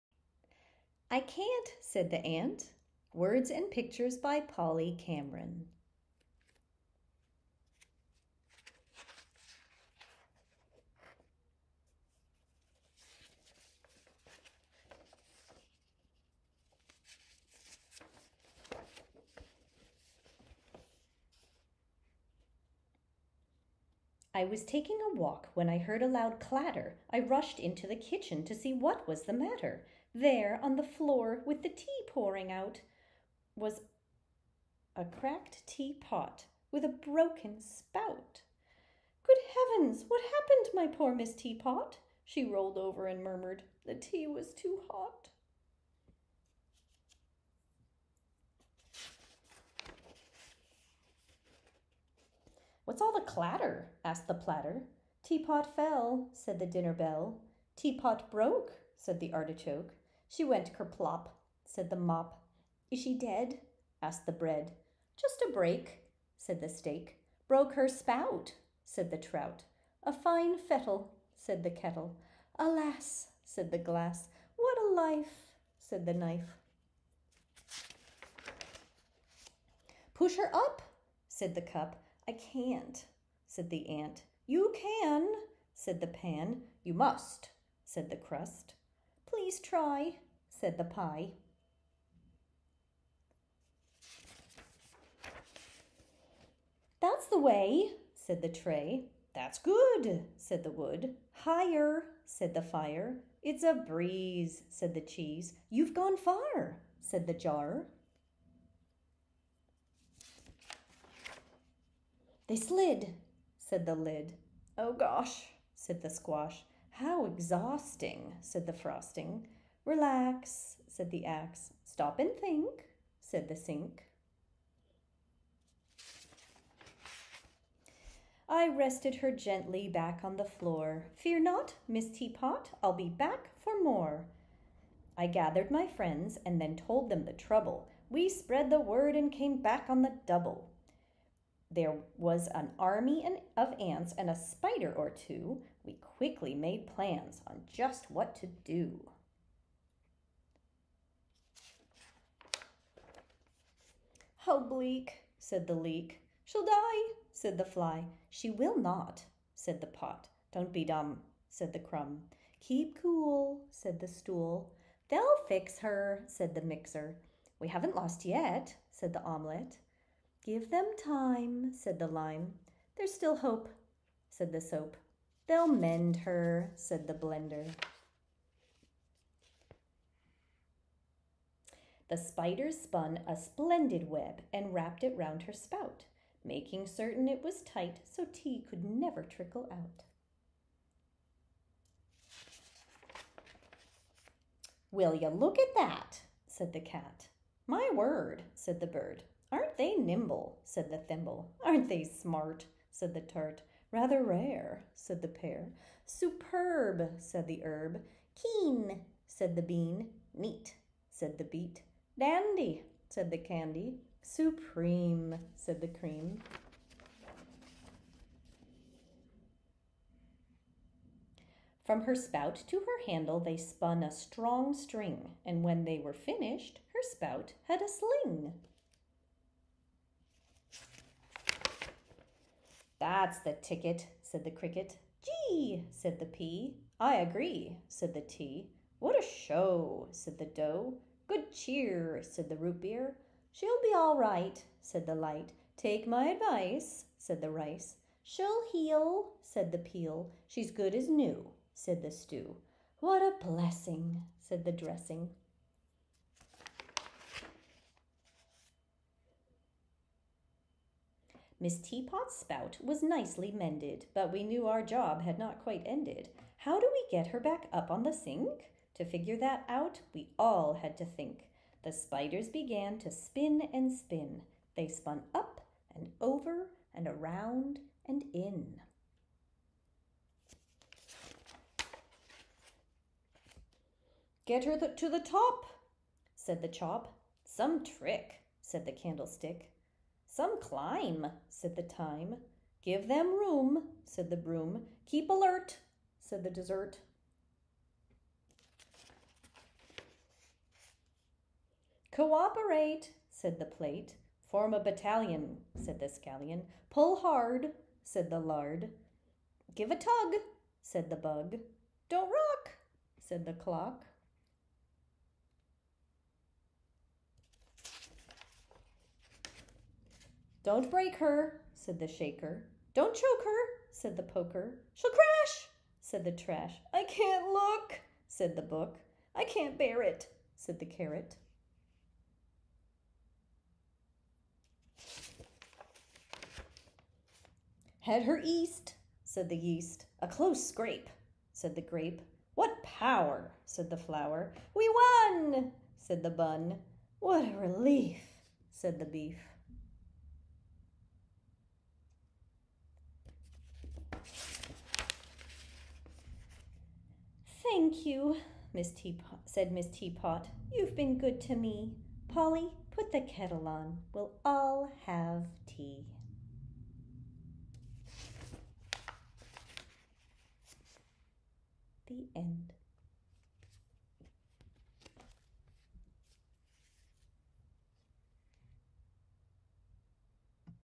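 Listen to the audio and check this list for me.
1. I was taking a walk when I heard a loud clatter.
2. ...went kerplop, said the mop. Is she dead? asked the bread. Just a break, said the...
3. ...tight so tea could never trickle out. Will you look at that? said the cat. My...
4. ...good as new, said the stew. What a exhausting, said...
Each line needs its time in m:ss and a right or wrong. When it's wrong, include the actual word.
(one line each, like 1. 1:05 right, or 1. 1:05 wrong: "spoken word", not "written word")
1. 0:24 right
2. 1:00 right
3. 3:07 right
4. 4:10 wrong: "blessing", not "exhausting".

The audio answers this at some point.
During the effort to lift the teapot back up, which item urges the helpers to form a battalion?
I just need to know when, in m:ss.
5:05.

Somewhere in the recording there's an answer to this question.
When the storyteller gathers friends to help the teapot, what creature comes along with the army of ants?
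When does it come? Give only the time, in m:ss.
2:24.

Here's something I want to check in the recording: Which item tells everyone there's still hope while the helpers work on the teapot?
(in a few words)
soap.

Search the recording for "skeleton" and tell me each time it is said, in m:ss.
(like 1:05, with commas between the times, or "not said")
not said.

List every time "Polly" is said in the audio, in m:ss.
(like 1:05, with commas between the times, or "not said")
0:04, 6:02.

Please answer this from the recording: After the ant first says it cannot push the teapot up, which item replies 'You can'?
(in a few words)
pan.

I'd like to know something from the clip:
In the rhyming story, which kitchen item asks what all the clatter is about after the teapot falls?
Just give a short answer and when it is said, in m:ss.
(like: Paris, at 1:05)
platter, at 0:54.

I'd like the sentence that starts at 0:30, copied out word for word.
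There, on the floor, with the tea pouring out, was a cracked teapot with a broken spout.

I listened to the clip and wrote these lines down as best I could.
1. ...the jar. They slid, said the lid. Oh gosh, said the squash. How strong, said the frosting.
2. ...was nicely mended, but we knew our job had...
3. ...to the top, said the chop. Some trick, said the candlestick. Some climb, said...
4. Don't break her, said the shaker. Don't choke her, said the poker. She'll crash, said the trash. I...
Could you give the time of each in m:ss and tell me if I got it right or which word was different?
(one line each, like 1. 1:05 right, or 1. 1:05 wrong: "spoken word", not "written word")
1. 1:47 wrong: "exhausting", not "strong"
2. 4:22 right
3. 4:44 right
4. 5:20 right.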